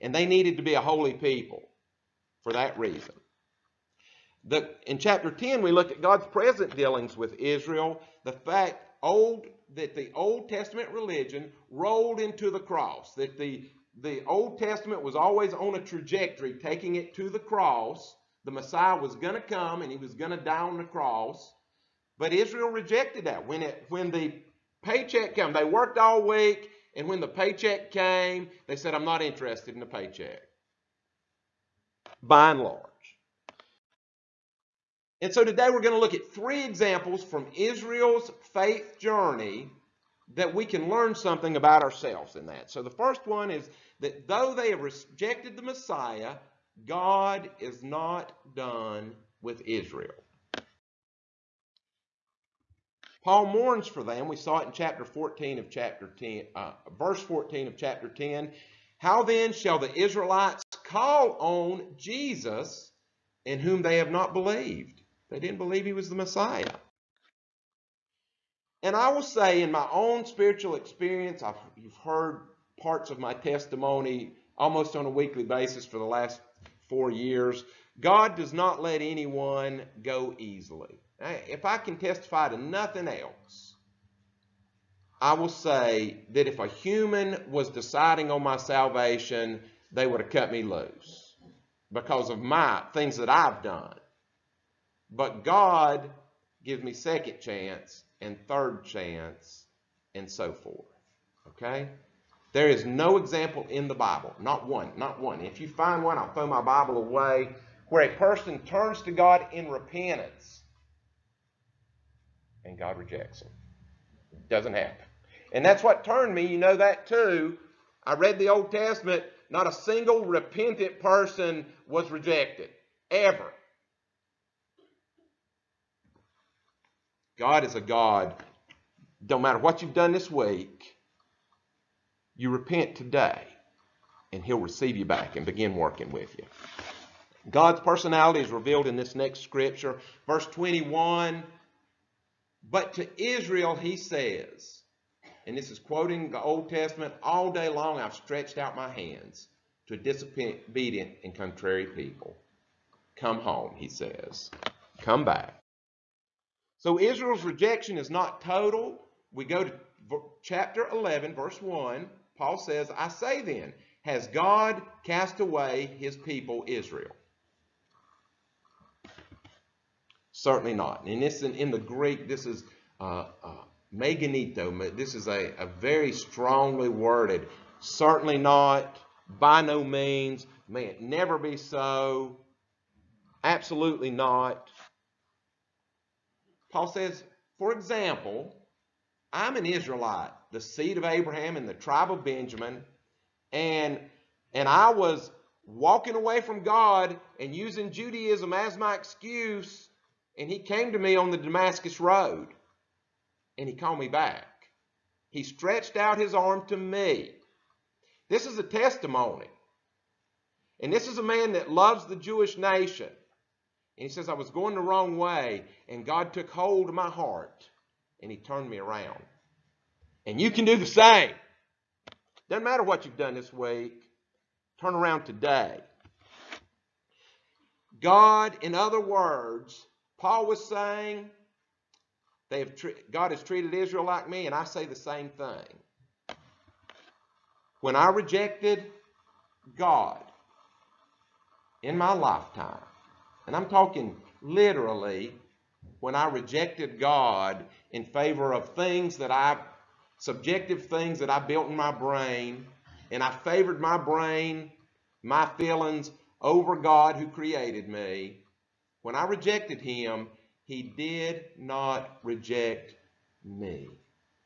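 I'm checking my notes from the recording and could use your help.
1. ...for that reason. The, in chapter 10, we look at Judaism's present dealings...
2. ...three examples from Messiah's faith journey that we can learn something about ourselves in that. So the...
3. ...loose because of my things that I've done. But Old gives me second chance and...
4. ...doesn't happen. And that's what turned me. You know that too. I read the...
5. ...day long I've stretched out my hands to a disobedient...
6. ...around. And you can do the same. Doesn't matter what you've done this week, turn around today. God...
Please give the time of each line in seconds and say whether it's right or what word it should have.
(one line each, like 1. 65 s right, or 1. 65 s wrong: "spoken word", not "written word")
1. 2 s wrong: "God", not "Judaism"
2. 36 s wrong: "Israel", not "Messiah"
3. 90 s wrong: "God", not "Old"
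4. 114 s right
5. 147 s right
6. 218 s right.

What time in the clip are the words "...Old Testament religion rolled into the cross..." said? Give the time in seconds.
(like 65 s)
10 s.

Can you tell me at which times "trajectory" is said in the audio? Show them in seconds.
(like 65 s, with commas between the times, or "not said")
15 s.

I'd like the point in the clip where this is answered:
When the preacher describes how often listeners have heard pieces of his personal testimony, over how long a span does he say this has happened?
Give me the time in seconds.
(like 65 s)
76 s.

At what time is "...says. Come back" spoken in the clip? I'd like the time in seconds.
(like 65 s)
153 s.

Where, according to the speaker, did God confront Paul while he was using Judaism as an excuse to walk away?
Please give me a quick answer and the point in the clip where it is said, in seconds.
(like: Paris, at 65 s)
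Damascus road, at 201 s.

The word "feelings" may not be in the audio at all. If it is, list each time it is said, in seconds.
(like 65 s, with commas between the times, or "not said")
255 s.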